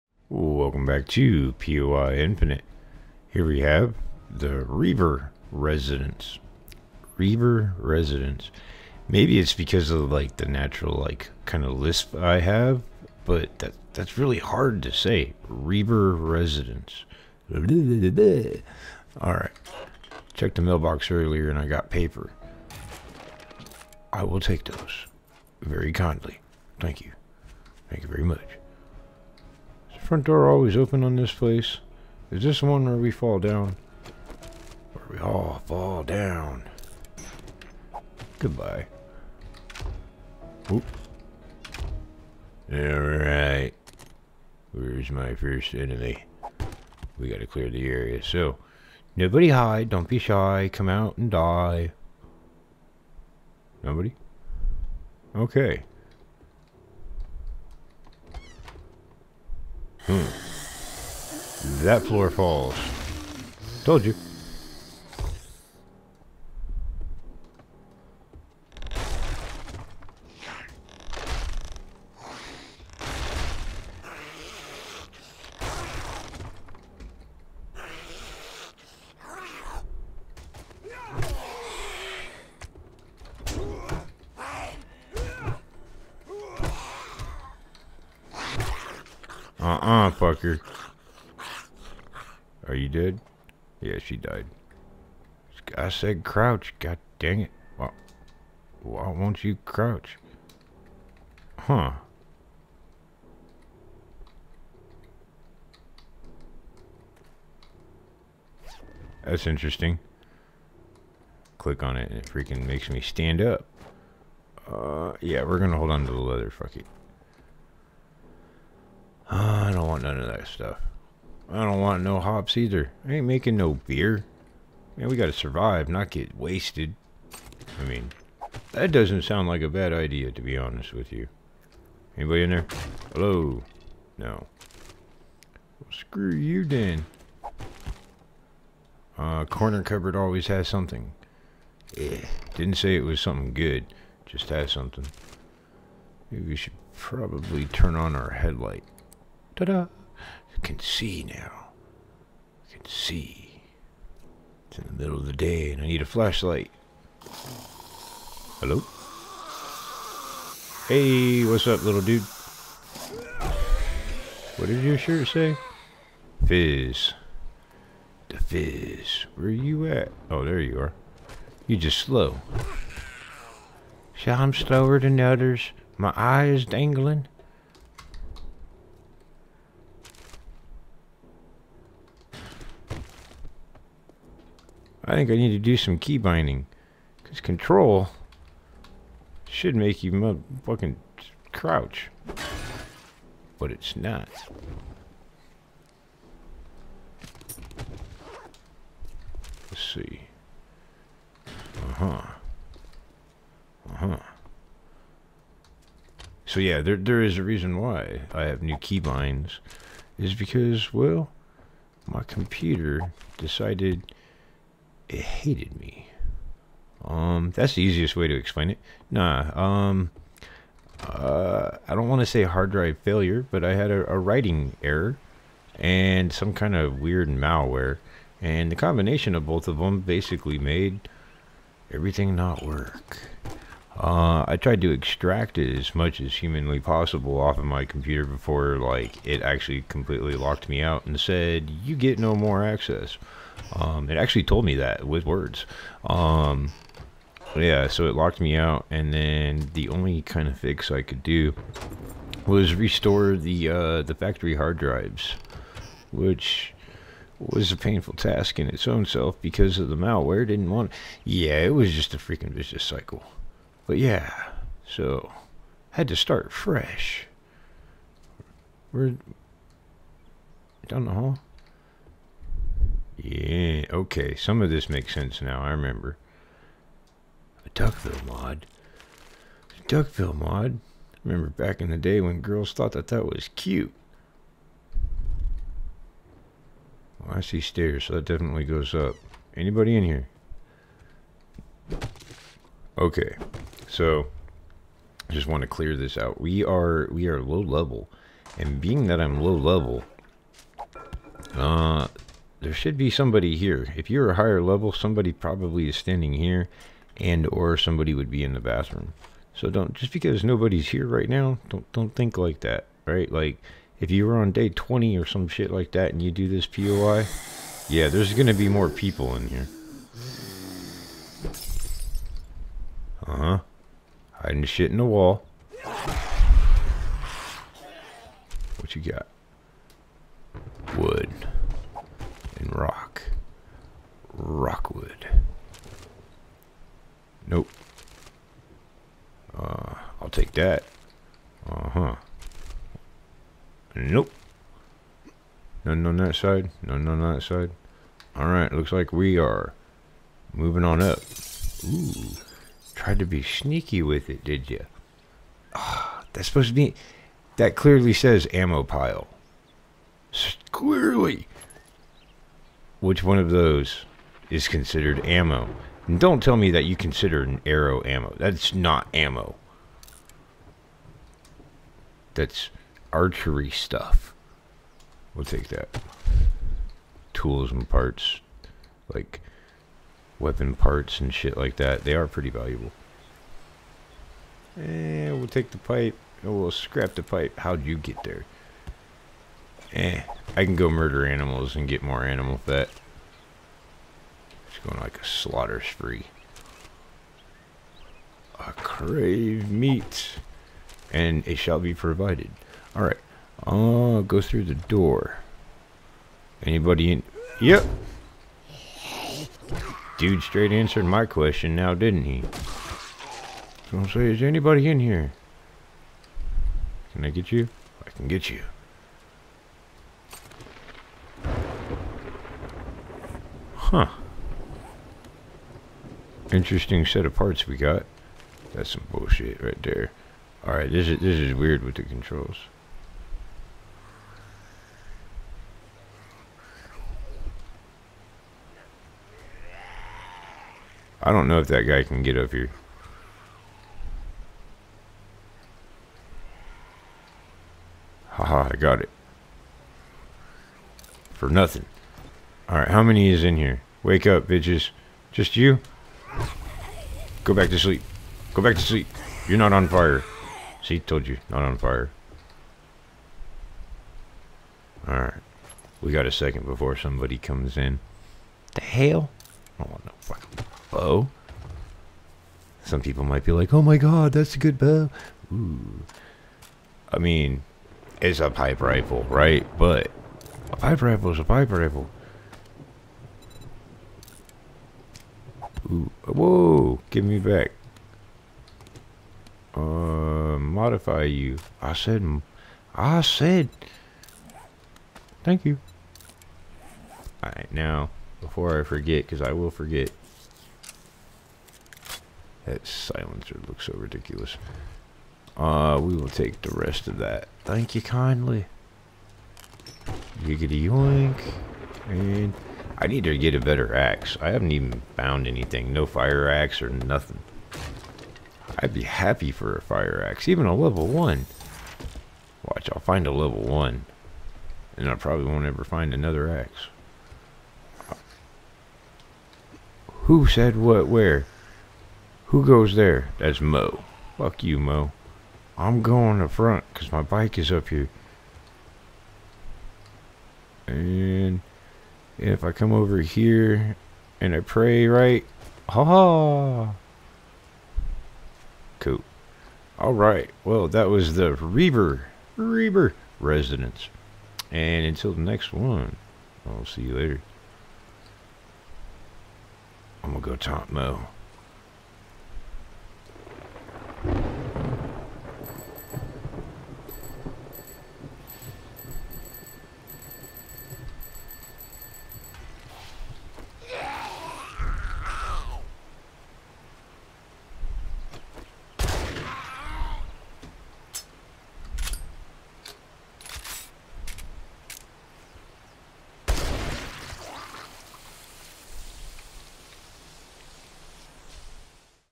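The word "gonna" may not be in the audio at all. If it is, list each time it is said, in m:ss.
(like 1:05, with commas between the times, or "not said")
1:55, 9:20.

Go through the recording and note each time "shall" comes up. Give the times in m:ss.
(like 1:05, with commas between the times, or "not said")
6:41.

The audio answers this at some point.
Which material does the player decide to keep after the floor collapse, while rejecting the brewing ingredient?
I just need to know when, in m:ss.
1:56.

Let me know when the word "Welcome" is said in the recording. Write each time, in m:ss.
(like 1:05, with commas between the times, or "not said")
0:00.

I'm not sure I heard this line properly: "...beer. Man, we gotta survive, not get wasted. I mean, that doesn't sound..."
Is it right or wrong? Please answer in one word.
right.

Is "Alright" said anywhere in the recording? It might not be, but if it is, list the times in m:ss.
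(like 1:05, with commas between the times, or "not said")
0:17, 0:42, 5:48, 6:42, 7:10, 7:32, 7:45, 8:17.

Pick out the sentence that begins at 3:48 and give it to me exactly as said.
And the combination of both of them basically made everything not work.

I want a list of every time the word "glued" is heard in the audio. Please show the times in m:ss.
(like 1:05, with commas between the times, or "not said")
not said.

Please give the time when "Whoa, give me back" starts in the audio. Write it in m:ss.
8:06.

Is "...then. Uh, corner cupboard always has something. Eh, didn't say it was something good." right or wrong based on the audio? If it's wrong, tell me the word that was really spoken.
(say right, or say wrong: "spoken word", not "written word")
right.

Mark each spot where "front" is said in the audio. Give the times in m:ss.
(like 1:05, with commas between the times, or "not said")
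0:30, 8:56.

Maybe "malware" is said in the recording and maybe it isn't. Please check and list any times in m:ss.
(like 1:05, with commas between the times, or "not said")
3:47, 4:19.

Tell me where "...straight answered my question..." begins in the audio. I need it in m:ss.
6:50.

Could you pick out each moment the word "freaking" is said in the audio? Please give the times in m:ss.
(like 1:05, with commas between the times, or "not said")
1:52, 4:22.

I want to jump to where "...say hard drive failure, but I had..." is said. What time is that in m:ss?
3:42.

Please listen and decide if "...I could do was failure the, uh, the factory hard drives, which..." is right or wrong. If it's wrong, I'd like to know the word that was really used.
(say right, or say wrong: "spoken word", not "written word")
wrong: "restore", not "failure".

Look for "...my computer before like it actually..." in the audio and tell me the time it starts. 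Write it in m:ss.
3:57.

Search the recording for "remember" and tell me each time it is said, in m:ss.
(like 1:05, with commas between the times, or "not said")
4:35, 4:41.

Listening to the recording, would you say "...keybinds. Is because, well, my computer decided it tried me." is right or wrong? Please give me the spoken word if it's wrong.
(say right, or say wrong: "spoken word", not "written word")
wrong: "hated", not "tried".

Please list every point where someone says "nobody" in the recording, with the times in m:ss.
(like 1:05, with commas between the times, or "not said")
0:49, 0:53, 5:10.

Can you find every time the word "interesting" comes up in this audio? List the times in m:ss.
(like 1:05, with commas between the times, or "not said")
1:49, 7:06.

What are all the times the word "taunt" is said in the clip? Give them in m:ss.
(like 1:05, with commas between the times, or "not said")
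9:20.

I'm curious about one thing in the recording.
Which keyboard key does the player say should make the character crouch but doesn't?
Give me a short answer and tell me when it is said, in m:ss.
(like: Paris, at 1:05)
control, at 3:07.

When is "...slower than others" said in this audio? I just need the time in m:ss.
2:54.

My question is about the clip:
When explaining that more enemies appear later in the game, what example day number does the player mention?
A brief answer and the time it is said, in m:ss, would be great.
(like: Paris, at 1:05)
20, at 5:14.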